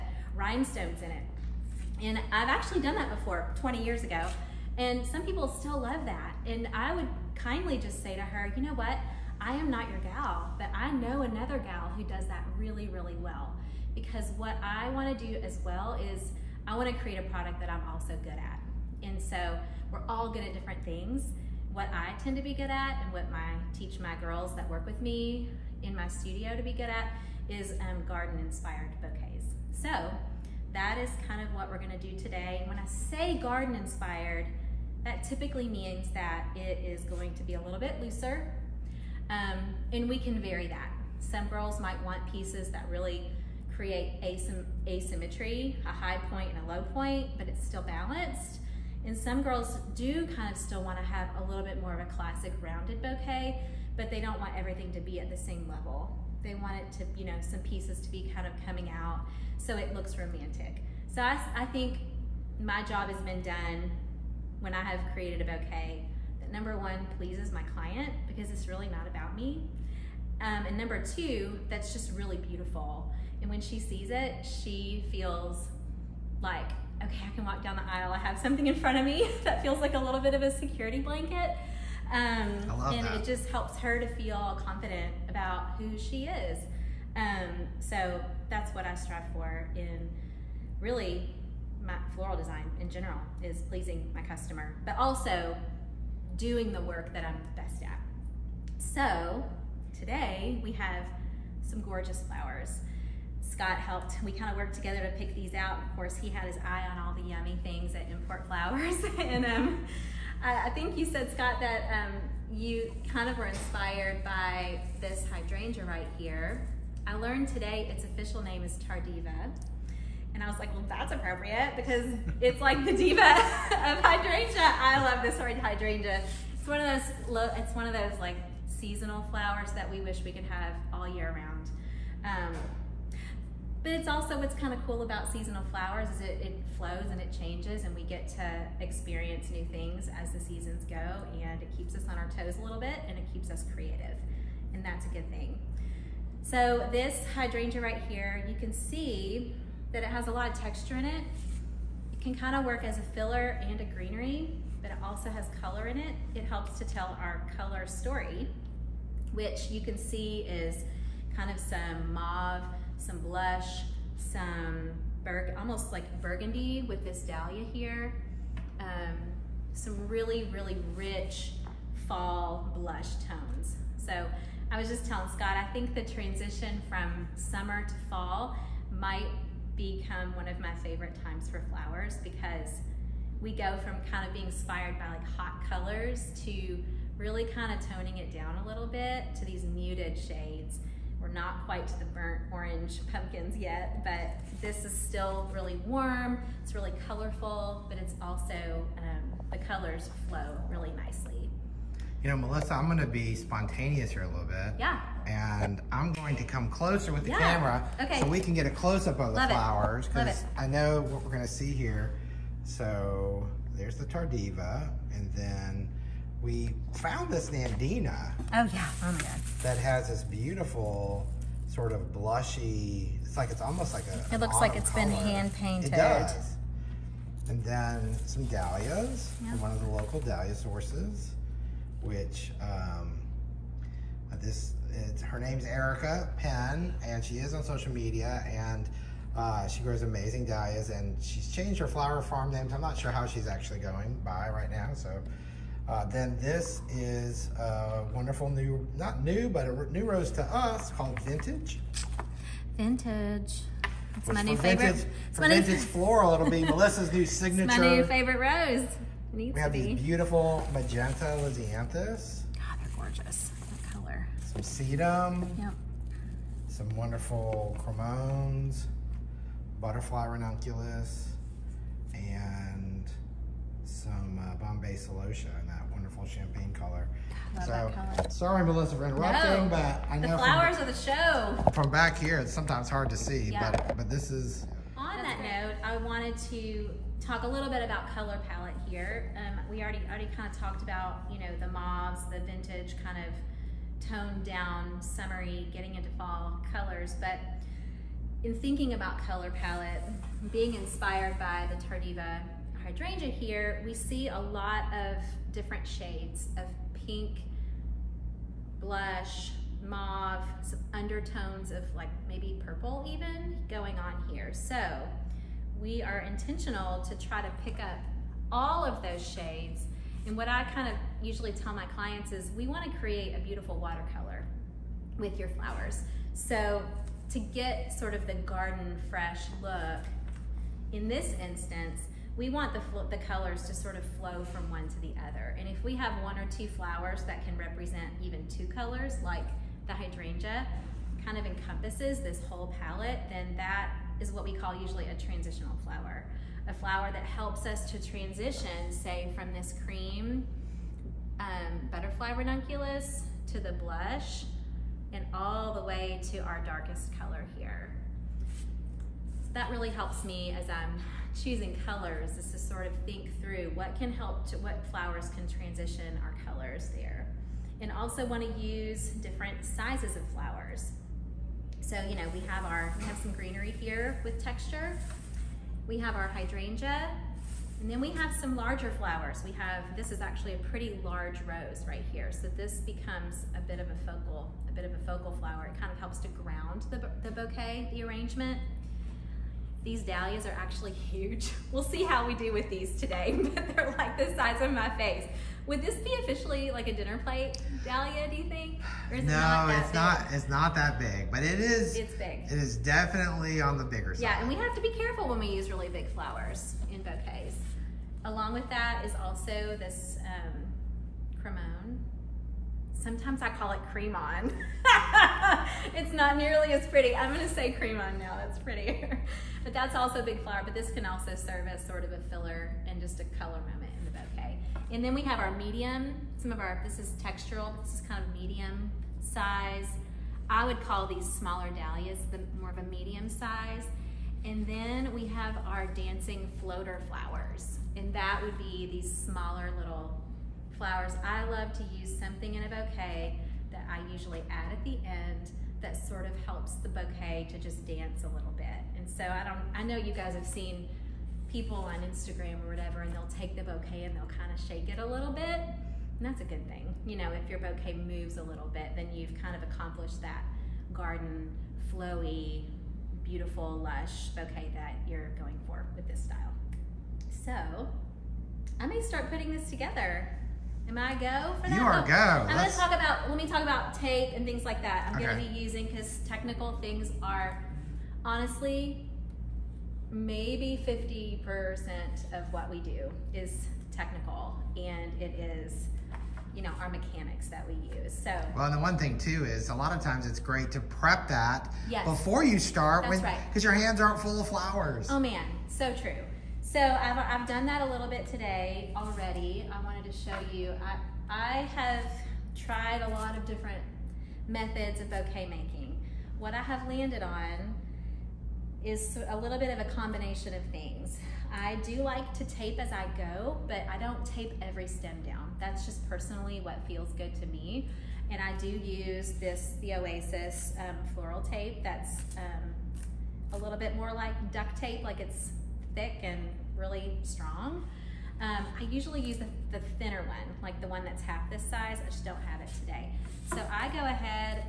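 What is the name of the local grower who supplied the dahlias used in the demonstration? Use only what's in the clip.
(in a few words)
Erica Penn.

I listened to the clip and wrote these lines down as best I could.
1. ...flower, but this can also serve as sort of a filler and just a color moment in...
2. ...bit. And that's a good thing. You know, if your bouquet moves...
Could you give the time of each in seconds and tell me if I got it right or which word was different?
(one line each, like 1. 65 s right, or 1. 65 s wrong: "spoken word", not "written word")
1. 420 s right
2. 455 s right.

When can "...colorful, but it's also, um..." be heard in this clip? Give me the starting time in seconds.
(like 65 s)
197 s.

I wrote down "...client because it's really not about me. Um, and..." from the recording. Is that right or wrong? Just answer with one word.
right.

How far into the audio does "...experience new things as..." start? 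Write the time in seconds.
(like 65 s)
138 s.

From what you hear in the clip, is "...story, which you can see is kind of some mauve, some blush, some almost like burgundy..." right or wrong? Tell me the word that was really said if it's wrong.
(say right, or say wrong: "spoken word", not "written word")
right.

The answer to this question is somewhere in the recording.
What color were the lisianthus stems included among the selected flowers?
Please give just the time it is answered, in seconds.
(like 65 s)
260 s.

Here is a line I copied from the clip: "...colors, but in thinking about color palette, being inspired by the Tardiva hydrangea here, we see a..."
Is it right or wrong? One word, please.
right.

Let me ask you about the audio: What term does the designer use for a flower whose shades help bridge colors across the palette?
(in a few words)
transitional flower.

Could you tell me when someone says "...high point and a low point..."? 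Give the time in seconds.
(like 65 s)
45 s.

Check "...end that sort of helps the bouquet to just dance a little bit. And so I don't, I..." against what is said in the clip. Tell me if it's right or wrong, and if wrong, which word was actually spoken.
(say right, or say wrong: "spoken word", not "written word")
right.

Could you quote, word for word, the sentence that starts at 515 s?
That's just personally what feels good to me.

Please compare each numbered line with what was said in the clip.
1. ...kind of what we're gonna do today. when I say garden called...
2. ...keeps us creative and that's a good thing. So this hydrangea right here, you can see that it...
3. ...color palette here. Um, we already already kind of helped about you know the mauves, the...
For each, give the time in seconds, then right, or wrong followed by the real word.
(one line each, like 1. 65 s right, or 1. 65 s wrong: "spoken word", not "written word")
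1. 31 s wrong: "inspired", not "called"
2. 143 s right
3. 288 s wrong: "talked", not "helped".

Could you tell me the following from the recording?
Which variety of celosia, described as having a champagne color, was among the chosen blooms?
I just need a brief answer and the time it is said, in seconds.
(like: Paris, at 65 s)
Bombay, at 274 s.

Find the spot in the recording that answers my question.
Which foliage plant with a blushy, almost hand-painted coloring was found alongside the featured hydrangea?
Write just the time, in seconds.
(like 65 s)
217 s.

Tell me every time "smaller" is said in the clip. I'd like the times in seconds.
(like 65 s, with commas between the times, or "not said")
431 s, 439 s.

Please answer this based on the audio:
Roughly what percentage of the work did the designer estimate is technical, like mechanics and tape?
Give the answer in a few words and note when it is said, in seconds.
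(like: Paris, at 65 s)
50%, at 480 s.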